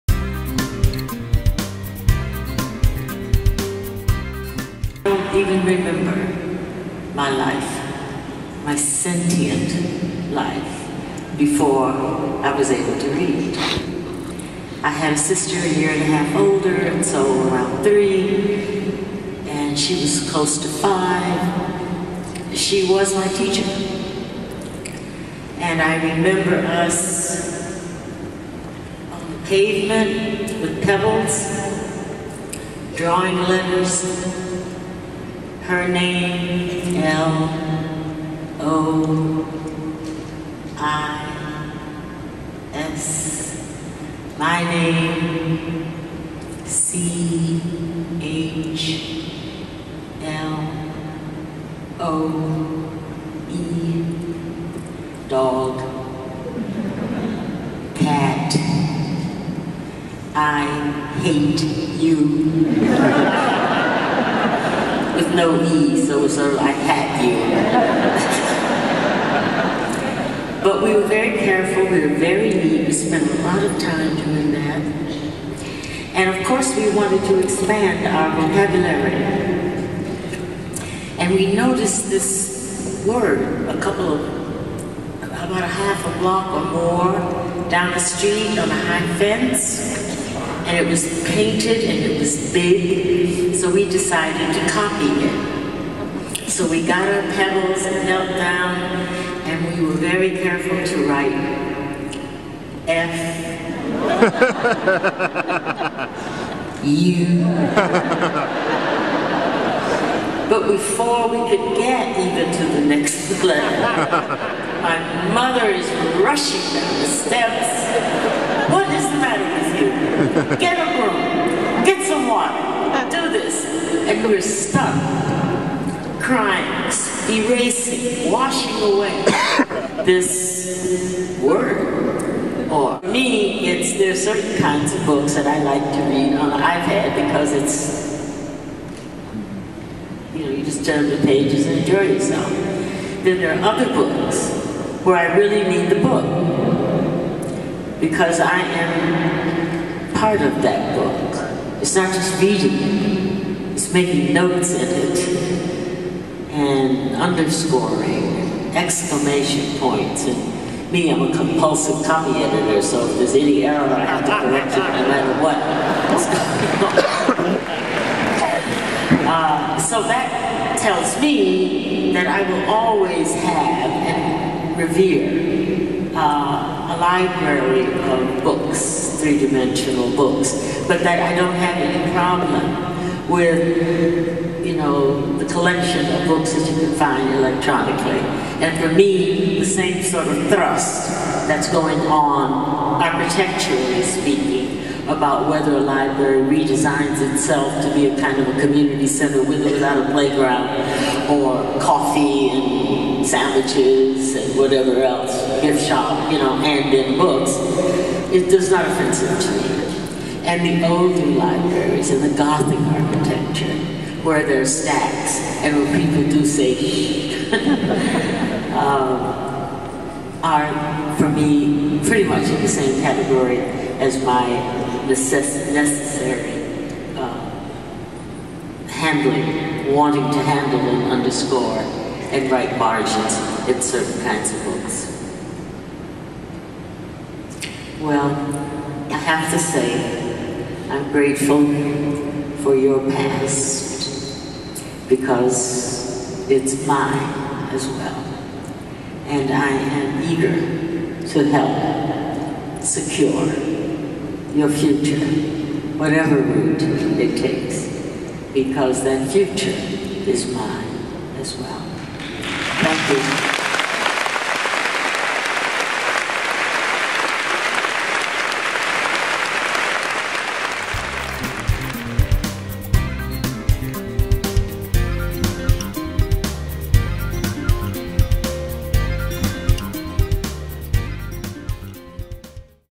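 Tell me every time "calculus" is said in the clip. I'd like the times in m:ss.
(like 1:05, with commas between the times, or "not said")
not said.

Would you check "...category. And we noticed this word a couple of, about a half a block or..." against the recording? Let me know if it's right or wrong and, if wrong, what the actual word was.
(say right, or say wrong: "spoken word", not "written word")
wrong: "vocabulary", not "category".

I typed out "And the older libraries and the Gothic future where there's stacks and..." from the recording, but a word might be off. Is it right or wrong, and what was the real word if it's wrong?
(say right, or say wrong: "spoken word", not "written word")
wrong: "architecture", not "future".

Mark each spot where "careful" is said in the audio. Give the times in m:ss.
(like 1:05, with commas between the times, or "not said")
1:11, 1:40.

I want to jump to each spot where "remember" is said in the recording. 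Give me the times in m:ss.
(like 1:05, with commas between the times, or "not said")
0:05, 0:26.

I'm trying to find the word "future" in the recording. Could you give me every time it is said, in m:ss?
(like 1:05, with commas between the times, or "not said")
4:14, 4:19.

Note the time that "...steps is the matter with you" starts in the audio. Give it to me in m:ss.
1:57.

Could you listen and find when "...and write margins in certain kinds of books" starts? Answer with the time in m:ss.
3:52.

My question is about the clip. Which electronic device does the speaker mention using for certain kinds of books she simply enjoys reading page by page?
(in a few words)
iPad.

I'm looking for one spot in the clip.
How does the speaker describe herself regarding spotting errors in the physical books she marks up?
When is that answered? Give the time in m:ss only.
2:41.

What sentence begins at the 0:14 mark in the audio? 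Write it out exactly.
I had a sister a year and a half older, and so around three, and she was close to five.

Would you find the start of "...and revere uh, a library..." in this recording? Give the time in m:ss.
2:53.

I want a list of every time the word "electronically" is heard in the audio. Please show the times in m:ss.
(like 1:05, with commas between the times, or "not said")
3:07.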